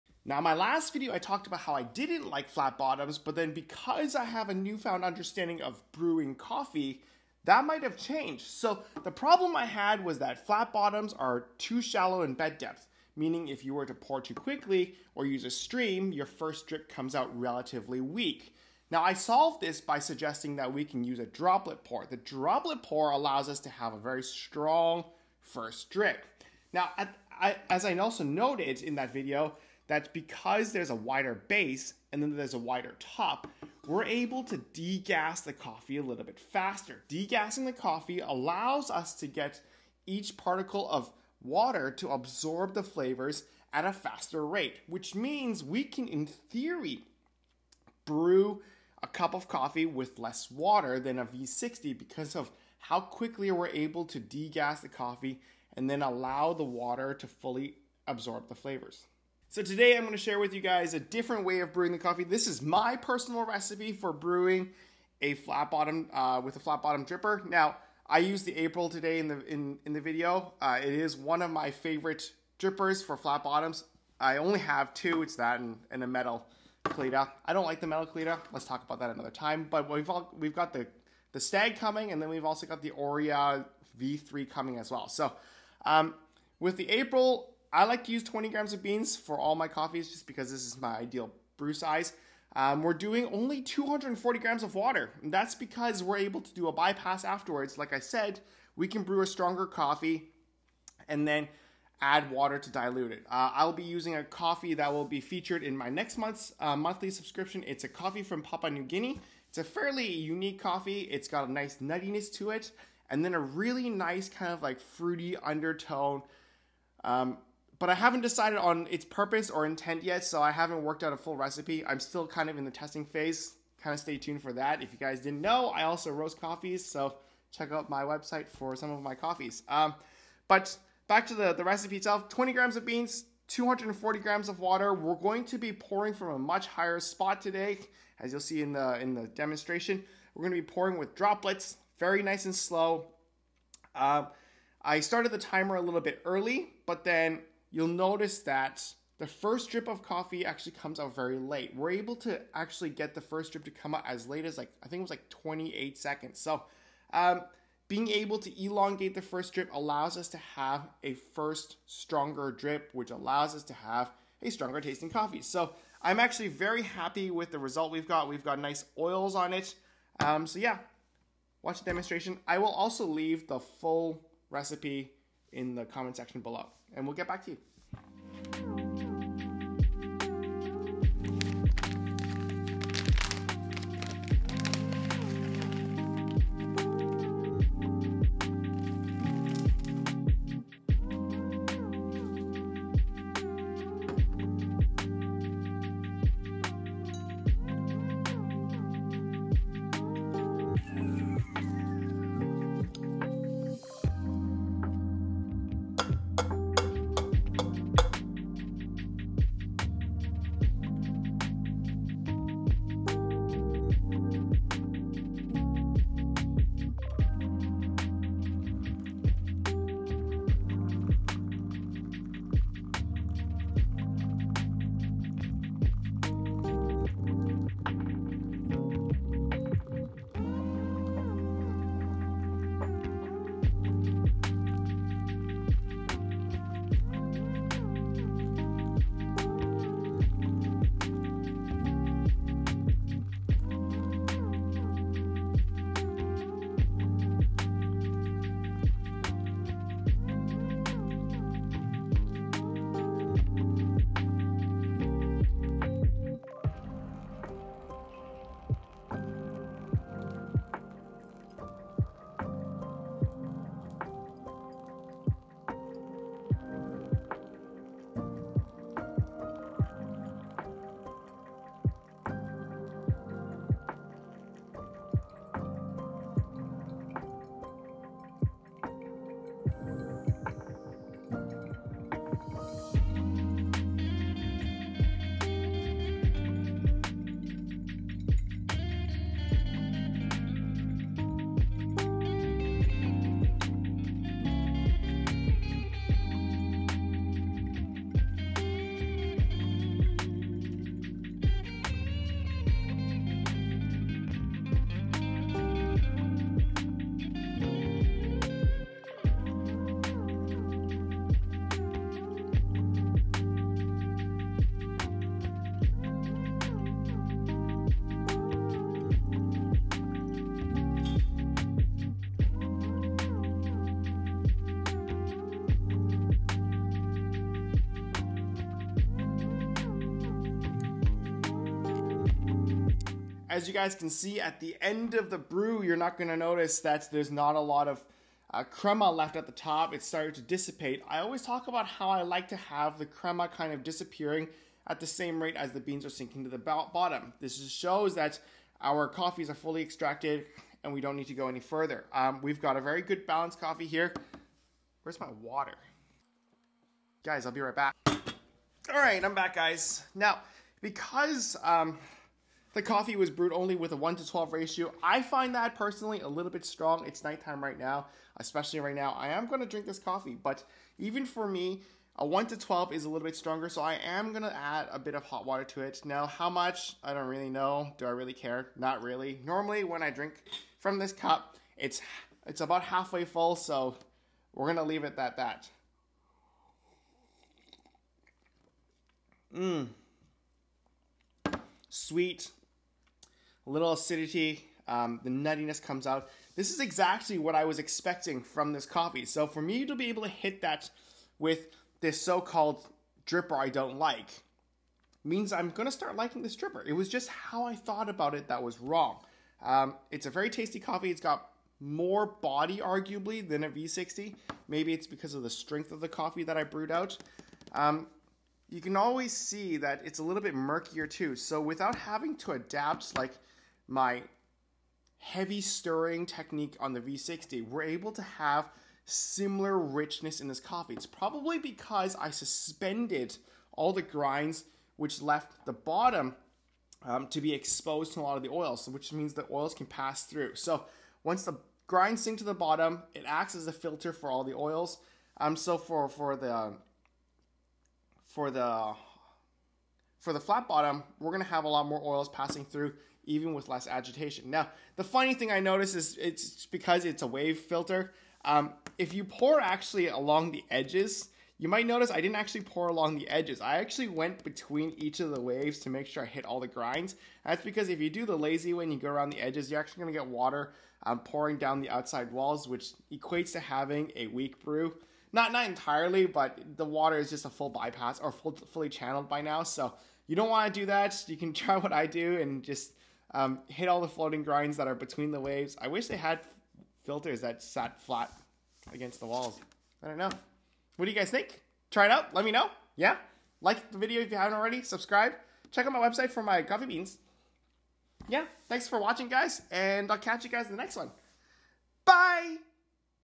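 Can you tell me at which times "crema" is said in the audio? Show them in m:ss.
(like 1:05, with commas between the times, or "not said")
5:38, 5:43.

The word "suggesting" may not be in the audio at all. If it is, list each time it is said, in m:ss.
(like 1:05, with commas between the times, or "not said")
0:19.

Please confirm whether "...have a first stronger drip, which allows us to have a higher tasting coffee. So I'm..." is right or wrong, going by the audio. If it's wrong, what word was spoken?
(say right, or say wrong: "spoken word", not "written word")
wrong: "stronger", not "higher".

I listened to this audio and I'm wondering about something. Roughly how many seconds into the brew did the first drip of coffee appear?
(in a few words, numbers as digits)
28 seconds.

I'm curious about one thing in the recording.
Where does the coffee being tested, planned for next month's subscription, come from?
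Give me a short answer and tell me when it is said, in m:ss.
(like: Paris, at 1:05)
Papua New Guinea, at 1:48.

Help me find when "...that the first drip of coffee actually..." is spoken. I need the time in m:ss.
2:28.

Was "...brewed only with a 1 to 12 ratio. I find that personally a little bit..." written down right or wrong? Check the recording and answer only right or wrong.
right.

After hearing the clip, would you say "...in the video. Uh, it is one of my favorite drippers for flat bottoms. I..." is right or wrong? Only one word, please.
right.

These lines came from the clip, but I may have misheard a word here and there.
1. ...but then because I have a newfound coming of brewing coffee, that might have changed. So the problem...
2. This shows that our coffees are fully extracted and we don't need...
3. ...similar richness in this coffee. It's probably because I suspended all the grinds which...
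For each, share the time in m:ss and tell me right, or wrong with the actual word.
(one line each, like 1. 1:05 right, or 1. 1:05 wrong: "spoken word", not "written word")
1. 0:03 wrong: "understanding", not "coming"
2. 5:47 right
3. 7:09 right.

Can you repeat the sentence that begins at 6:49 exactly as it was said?
Um, it's a very tasty coffee.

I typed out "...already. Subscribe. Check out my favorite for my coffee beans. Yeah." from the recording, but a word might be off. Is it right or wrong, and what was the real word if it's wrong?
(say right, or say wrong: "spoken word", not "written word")
wrong: "website", not "favorite".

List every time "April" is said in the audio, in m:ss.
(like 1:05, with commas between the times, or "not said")
1:08, 1:26.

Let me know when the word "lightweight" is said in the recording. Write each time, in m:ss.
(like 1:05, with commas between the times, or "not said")
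not said.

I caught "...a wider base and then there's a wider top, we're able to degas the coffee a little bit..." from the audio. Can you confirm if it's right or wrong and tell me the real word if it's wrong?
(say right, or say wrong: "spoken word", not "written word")
right.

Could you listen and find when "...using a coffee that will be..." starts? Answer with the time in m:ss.
1:43.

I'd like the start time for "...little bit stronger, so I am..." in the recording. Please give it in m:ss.
6:13.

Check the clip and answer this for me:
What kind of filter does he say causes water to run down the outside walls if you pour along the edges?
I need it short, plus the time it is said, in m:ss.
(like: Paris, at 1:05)
wave filter, at 7:37.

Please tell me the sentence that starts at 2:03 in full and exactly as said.
Kind of stay tuned for that.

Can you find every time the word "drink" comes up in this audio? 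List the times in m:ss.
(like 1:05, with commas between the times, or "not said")
6:09, 6:20.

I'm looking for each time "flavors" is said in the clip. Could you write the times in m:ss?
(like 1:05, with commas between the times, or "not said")
0:42, 0:58.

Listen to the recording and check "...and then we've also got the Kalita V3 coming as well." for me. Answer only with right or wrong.
wrong.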